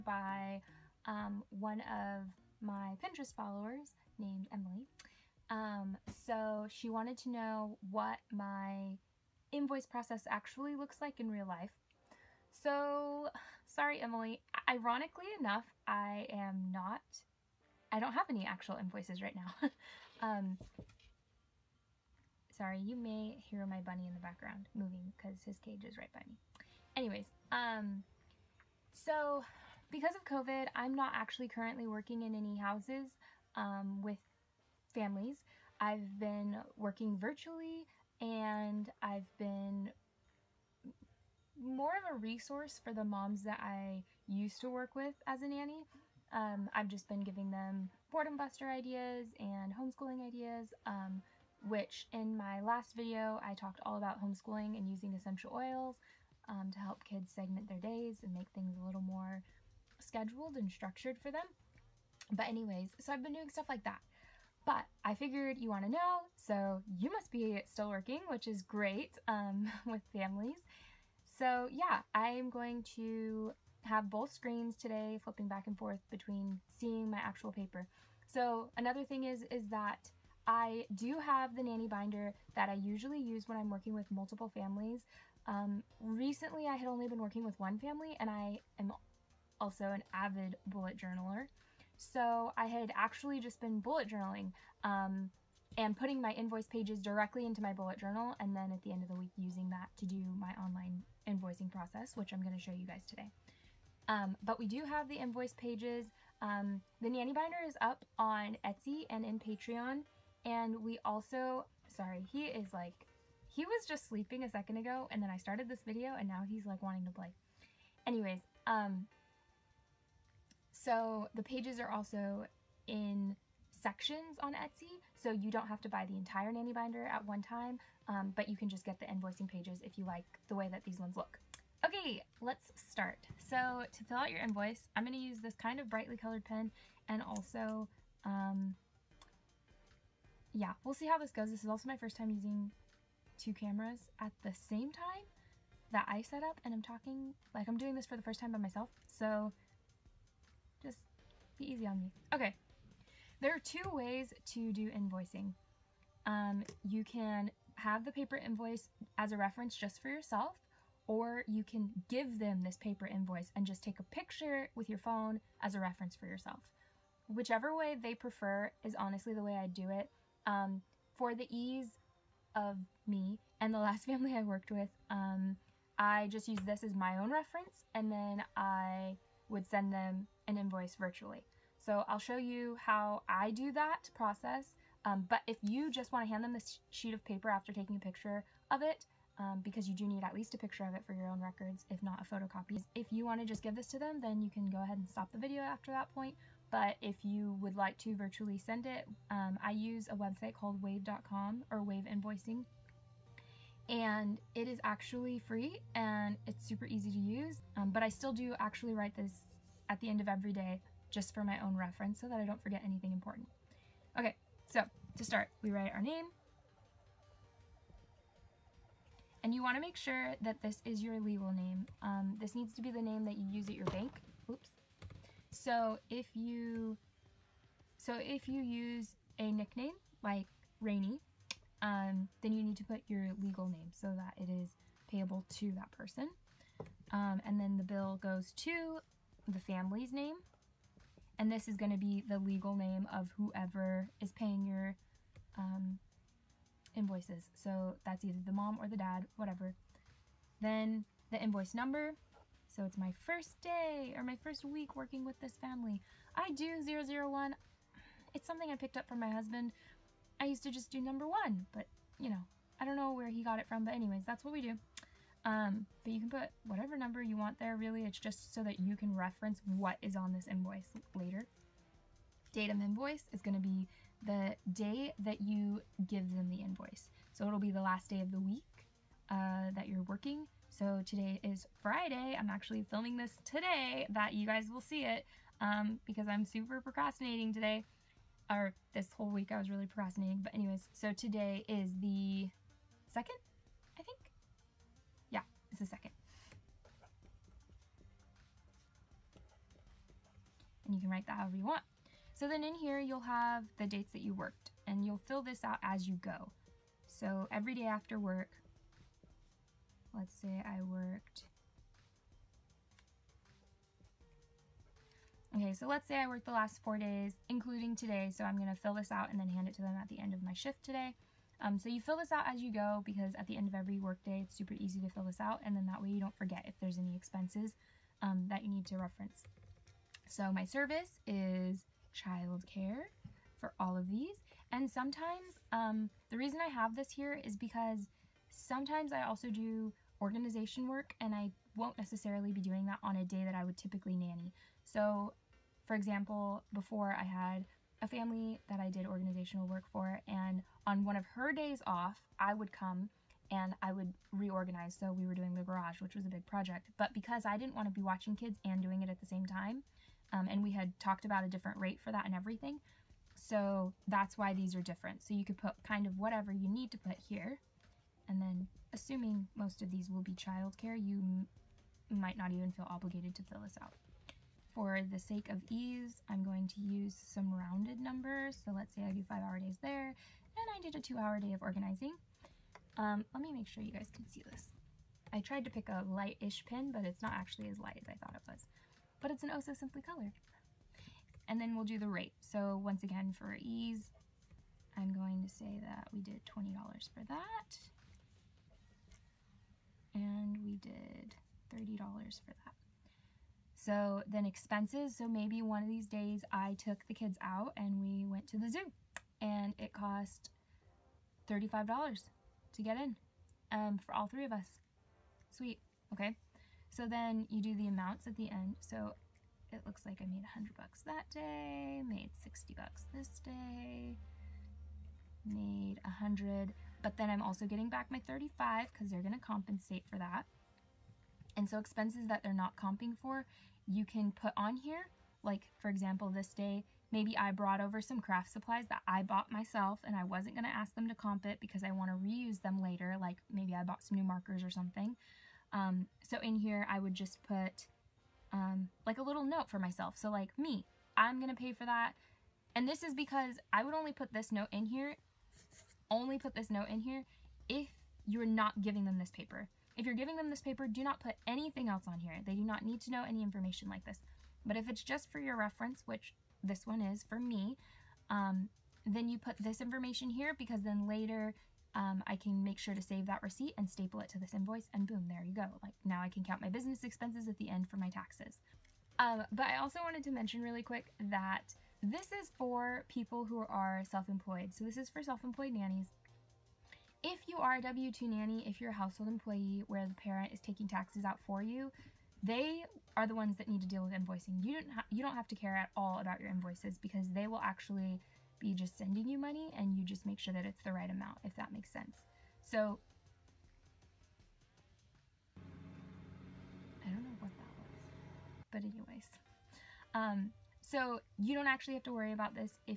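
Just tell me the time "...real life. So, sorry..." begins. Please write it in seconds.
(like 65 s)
11 s.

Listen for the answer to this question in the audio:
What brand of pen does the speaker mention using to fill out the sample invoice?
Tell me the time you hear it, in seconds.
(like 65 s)
389 s.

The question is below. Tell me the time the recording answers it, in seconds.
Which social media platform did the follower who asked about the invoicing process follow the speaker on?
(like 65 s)
3 s.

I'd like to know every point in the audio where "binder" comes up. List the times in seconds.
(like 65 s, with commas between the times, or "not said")
81 s, 107 s, 126 s.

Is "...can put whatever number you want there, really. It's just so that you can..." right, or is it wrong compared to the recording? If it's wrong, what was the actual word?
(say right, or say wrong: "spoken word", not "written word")
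right.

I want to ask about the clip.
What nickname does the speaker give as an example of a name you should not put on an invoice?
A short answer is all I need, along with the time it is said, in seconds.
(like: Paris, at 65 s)
Rainey, at 230 s.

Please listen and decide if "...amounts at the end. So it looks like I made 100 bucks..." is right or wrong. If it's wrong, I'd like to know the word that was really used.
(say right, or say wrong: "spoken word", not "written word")
right.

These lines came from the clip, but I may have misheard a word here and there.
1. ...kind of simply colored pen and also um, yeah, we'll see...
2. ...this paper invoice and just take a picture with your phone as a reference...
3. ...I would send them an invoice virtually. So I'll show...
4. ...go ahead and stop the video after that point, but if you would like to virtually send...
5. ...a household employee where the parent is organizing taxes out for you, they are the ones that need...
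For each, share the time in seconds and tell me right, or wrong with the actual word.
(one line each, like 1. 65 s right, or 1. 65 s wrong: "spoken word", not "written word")
1. 135 s wrong: "brightly", not "simply"
2. 162 s right
3. 178 s right
4. 194 s right
5. 488 s wrong: "taking", not "organizing".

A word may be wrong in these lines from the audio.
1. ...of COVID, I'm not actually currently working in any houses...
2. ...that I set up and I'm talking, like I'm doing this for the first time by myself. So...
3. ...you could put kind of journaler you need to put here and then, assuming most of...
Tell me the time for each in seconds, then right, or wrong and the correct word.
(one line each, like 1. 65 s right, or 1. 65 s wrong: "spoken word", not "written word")
1. 30 s right
2. 145 s right
3. 365 s wrong: "whatever", not "journaler".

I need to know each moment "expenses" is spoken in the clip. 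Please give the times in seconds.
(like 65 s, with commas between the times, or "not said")
327 s, 404 s, 431 s, 477 s.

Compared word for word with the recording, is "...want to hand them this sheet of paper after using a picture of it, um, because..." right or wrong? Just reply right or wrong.
wrong.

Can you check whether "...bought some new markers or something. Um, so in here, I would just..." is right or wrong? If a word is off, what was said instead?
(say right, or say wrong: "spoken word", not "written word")
right.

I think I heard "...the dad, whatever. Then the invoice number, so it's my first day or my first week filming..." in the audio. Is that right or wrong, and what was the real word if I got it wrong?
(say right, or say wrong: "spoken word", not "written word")
wrong: "working", not "filming".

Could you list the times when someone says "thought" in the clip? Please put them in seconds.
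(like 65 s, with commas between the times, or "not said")
388 s.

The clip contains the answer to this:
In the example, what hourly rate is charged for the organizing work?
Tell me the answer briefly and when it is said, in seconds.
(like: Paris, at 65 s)
$30, at 401 s.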